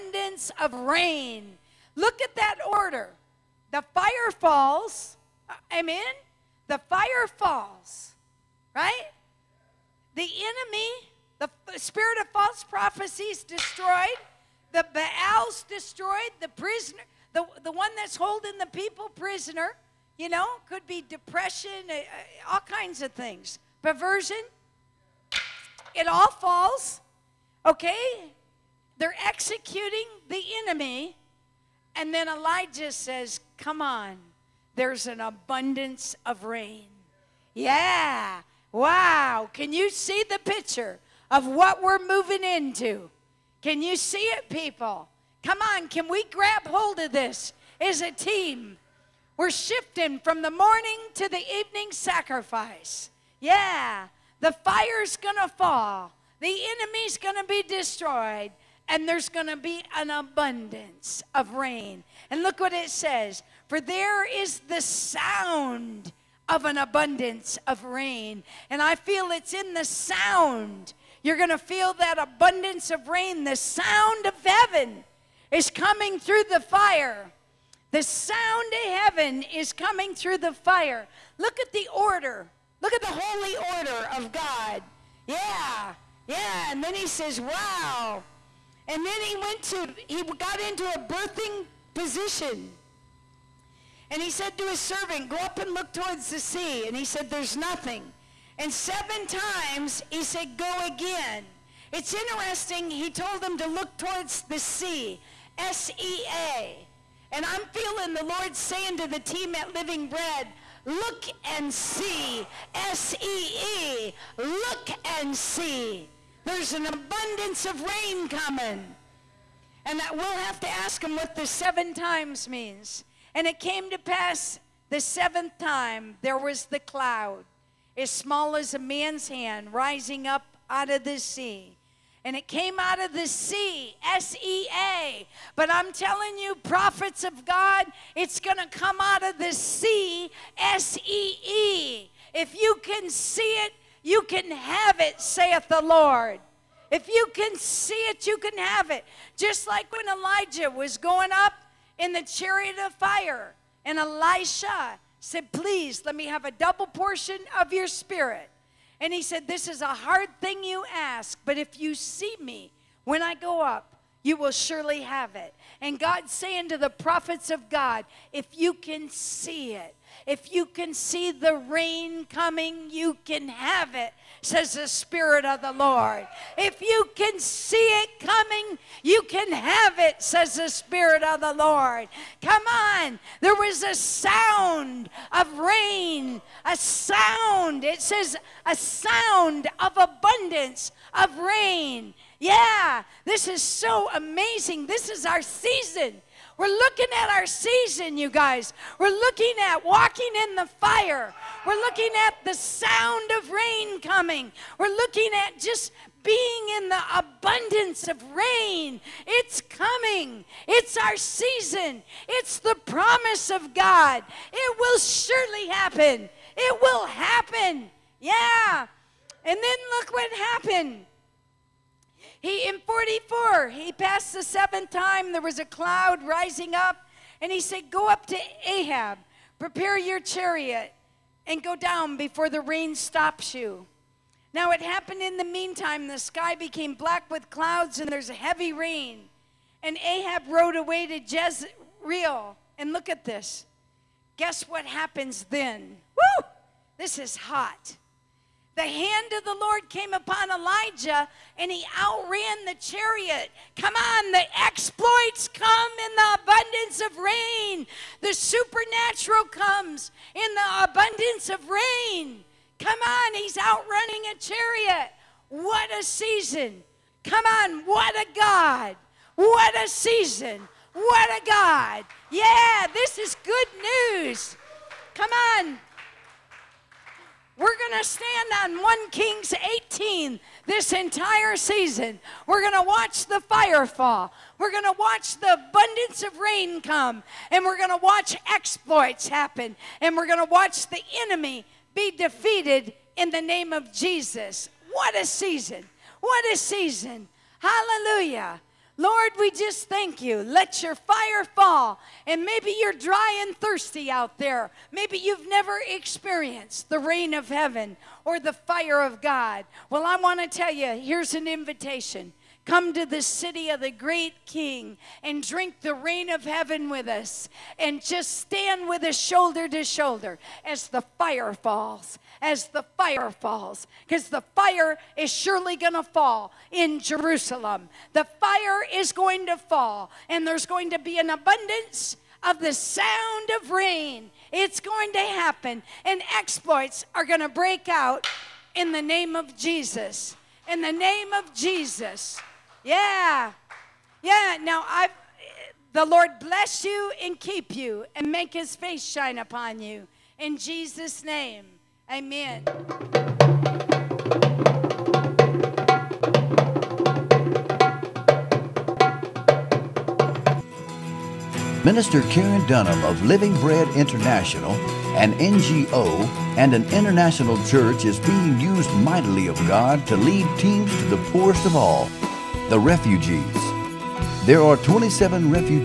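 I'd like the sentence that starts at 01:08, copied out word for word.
And I feel it's in the sound you're going to feel that abundance of rain.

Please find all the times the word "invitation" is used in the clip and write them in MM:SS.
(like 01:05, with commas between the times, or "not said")
05:11.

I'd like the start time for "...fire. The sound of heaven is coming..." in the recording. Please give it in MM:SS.
01:16.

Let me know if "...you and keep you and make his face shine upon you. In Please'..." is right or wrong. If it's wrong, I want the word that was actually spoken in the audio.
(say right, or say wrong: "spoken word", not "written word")
wrong: "Jesus", not "Please".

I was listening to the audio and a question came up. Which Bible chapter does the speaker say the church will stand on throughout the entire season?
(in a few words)
1 Kings 18.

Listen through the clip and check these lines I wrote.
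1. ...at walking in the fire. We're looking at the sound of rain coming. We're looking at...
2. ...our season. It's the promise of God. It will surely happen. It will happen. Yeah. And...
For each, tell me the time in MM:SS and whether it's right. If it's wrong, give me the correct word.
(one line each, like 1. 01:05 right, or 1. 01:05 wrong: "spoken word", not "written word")
1. 03:19 right
2. 03:30 right.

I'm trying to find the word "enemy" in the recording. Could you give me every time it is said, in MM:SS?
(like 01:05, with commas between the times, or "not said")
00:10, 00:30, 00:56, 04:51.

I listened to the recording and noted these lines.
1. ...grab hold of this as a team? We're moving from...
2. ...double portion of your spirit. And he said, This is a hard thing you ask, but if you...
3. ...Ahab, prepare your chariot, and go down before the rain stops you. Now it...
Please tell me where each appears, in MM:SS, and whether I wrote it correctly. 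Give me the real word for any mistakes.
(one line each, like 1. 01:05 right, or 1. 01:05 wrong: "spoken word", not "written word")
1. 00:46 wrong: "shifting", not "moving"
2. 02:36 right
3. 03:48 right.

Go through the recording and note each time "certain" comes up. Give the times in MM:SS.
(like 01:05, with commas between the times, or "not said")
not said.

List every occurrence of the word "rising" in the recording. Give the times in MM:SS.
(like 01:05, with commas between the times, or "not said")
02:09, 03:46.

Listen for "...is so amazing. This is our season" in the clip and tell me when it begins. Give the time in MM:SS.
03:13.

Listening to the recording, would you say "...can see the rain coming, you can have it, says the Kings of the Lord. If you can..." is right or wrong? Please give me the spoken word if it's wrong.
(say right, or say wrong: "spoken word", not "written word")
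wrong: "Spirit", not "Kings".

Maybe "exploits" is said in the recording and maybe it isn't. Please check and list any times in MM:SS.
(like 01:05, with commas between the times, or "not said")
04:14, 04:48, 05:36.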